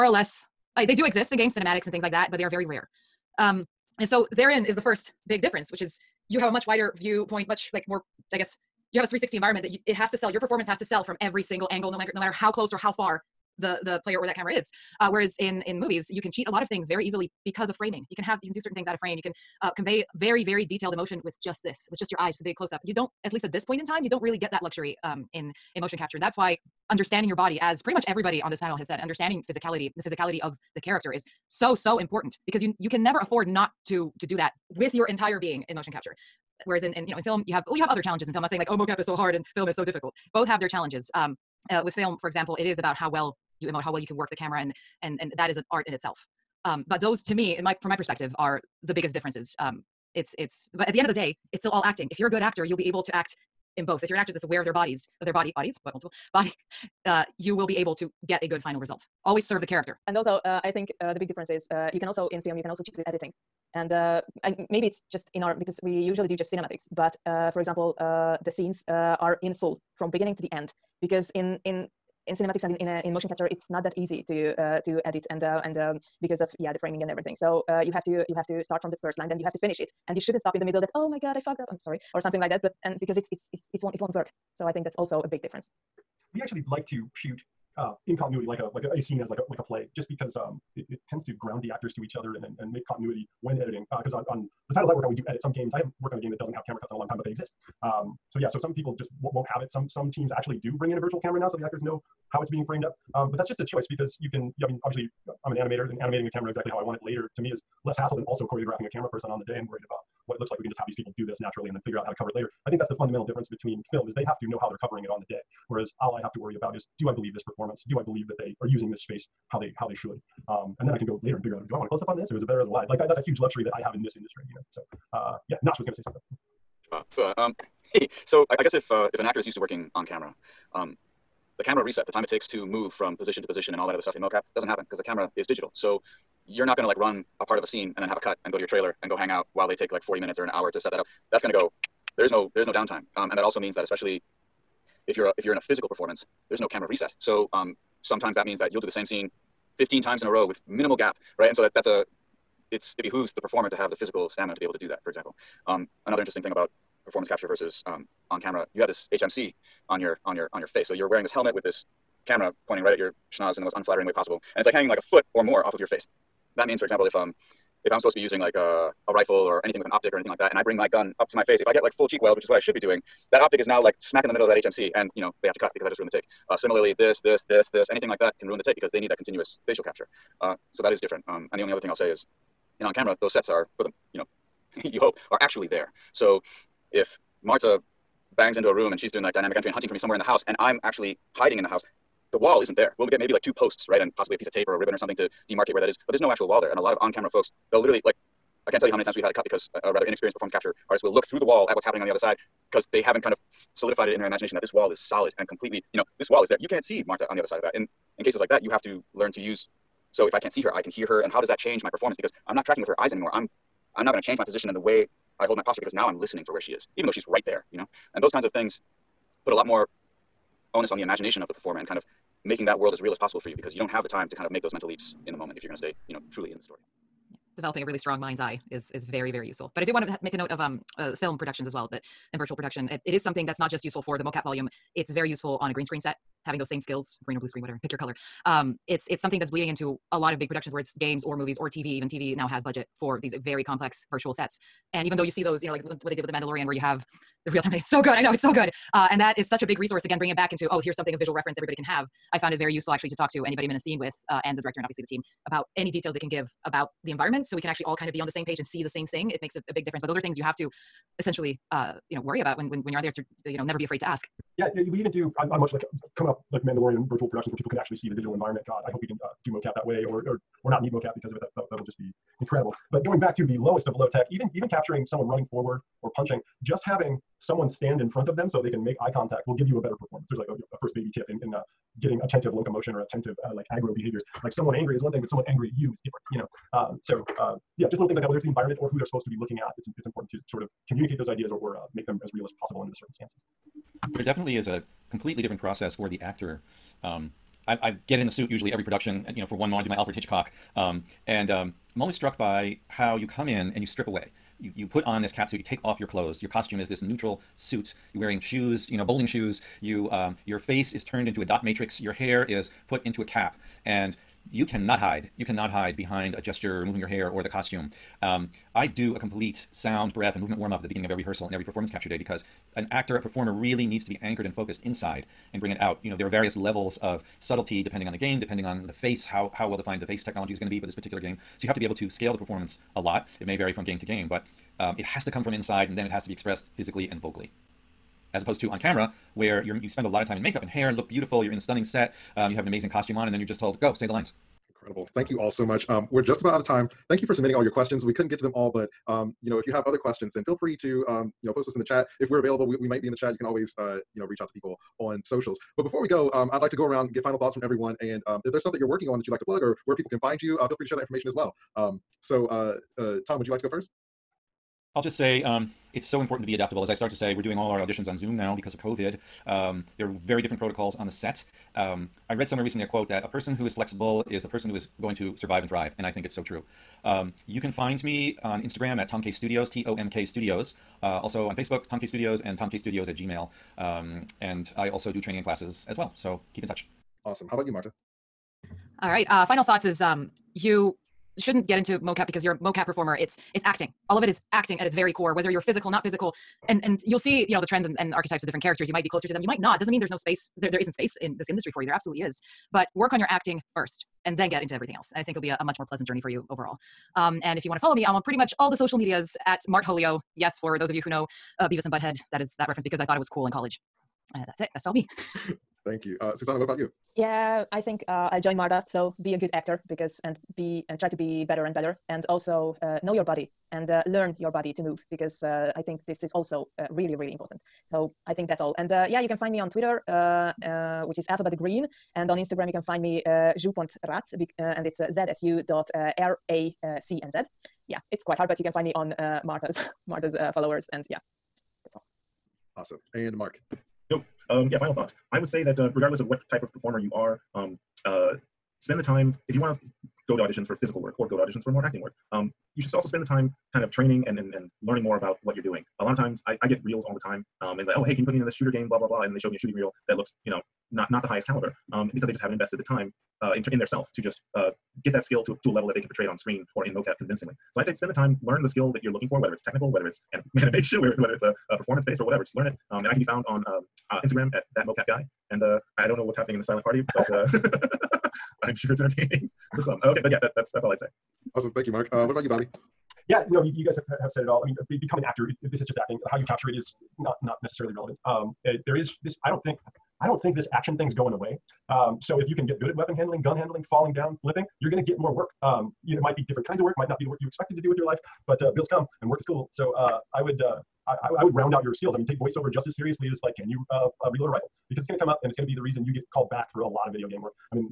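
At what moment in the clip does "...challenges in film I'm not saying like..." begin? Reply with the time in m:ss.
0:38.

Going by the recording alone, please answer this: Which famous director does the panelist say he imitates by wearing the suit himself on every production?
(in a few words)
Alfred Hitchcock.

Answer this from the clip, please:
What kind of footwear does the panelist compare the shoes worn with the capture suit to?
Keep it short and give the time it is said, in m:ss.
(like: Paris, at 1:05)
Bowling shoes, at 5:09.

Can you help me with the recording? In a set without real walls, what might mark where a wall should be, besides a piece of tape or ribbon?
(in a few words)
Two posts.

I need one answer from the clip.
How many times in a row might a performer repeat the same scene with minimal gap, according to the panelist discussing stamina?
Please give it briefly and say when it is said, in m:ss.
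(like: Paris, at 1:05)
15, at 2:29.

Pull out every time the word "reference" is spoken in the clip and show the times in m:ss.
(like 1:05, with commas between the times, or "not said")
4:11, 6:52.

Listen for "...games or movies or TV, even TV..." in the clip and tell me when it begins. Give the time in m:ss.
4:00.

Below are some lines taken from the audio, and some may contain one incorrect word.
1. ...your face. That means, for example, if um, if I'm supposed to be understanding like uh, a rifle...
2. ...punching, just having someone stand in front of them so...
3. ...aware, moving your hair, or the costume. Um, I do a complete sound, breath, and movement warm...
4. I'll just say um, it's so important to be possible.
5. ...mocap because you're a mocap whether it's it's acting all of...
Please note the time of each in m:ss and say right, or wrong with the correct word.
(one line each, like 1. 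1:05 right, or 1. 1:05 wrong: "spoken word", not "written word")
1. 2:45 wrong: "using", not "understanding"
2. 4:36 right
3. 5:16 wrong: "gesture", not "aware"
4. 6:04 wrong: "adaptable", not "possible"
5. 6:31 wrong: "performer", not "whether".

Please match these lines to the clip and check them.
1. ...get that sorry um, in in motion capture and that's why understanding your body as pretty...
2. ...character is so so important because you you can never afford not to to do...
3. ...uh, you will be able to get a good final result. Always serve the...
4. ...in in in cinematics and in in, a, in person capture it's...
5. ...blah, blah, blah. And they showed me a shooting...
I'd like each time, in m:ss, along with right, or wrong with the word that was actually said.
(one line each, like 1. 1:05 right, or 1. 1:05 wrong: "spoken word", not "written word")
1. 0:24 wrong: "luxury", not "sorry"
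2. 0:30 right
3. 0:57 right
4. 1:11 wrong: "motion", not "person"
5. 7:38 right.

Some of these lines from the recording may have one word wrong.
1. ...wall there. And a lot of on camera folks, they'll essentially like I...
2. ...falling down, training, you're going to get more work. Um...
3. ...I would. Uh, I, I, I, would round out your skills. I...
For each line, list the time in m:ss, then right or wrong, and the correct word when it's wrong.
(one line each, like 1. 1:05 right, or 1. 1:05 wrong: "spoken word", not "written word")
1. 3:16 wrong: "literally", not "essentially"
2. 8:13 wrong: "flipping", not "training"
3. 8:20 right.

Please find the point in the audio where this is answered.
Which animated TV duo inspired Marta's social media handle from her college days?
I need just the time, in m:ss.
6:51.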